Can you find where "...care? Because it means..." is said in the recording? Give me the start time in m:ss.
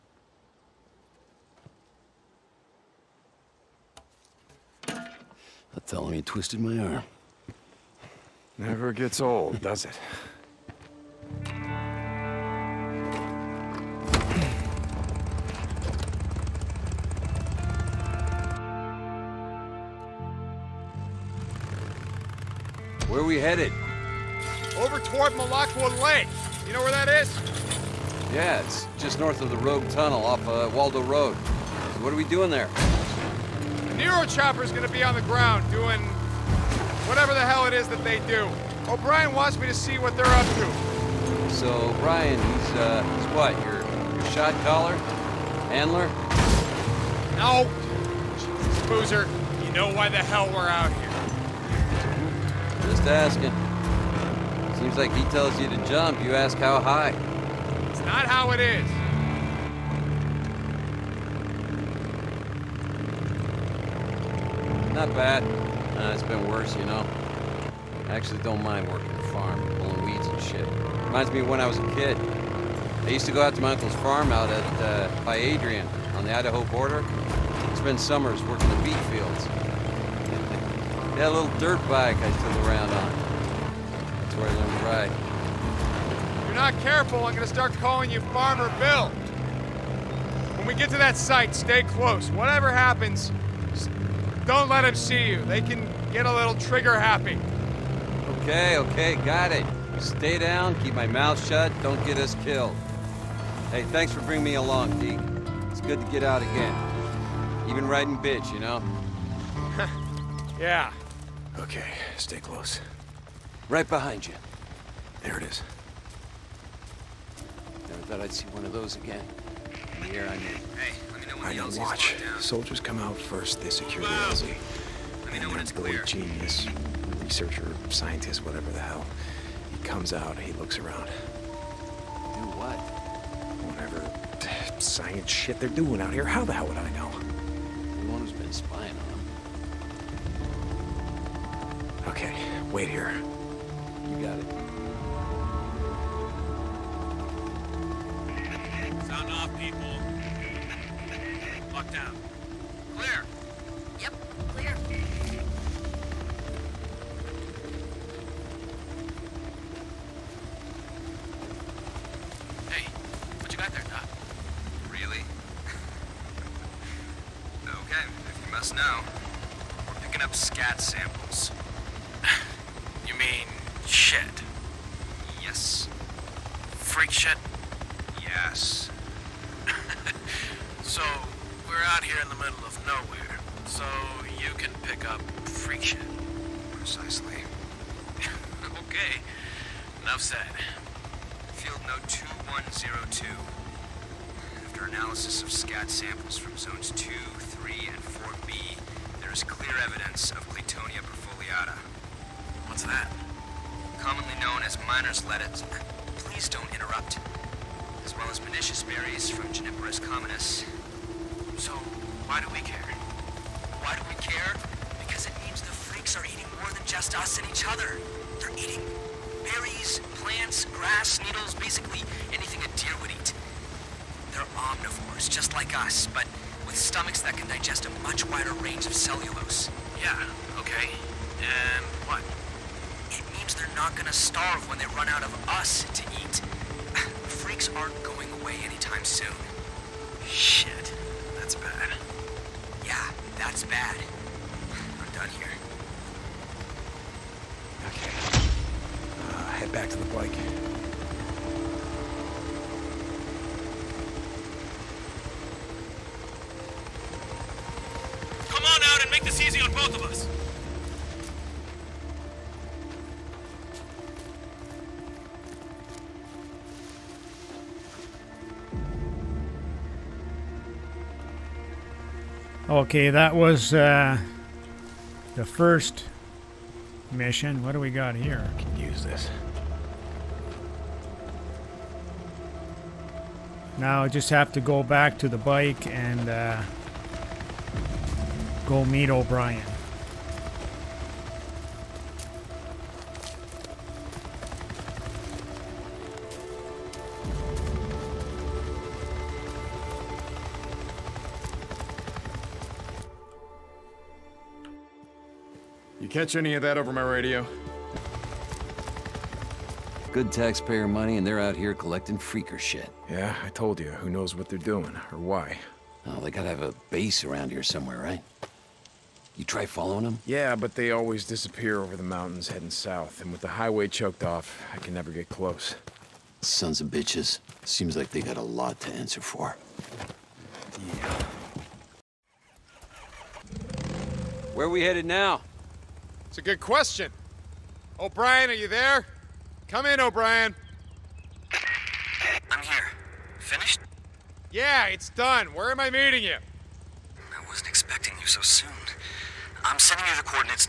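3:34.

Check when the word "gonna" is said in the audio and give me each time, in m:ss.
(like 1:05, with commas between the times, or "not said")
0:34, 1:27, 3:53.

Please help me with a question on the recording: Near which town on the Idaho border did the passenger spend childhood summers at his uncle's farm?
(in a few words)
Adrian.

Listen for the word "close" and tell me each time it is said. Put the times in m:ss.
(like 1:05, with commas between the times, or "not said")
1:31, 1:52, 5:25.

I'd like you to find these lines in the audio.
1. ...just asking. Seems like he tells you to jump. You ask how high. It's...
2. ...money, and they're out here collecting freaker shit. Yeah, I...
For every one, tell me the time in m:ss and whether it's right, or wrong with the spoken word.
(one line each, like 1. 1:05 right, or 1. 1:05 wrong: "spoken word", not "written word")
1. 0:53 right
2. 5:10 right.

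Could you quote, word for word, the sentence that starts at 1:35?
They can get a little trigger happy.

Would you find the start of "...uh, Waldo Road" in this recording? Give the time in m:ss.
0:30.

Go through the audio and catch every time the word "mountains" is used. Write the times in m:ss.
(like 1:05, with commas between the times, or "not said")
5:22.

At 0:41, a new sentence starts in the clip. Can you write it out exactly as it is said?
So O'Brien, he's, uh, he's what, your, your shot caller?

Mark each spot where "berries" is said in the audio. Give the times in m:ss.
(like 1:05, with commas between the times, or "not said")
3:28, 3:39.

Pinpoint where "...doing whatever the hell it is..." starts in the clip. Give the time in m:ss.
0:35.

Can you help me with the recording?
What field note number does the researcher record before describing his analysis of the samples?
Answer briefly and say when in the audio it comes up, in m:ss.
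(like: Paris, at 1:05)
2102, at 3:12.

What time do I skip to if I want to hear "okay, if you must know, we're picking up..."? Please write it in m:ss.
2:47.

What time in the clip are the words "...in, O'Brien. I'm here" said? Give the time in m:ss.
5:39.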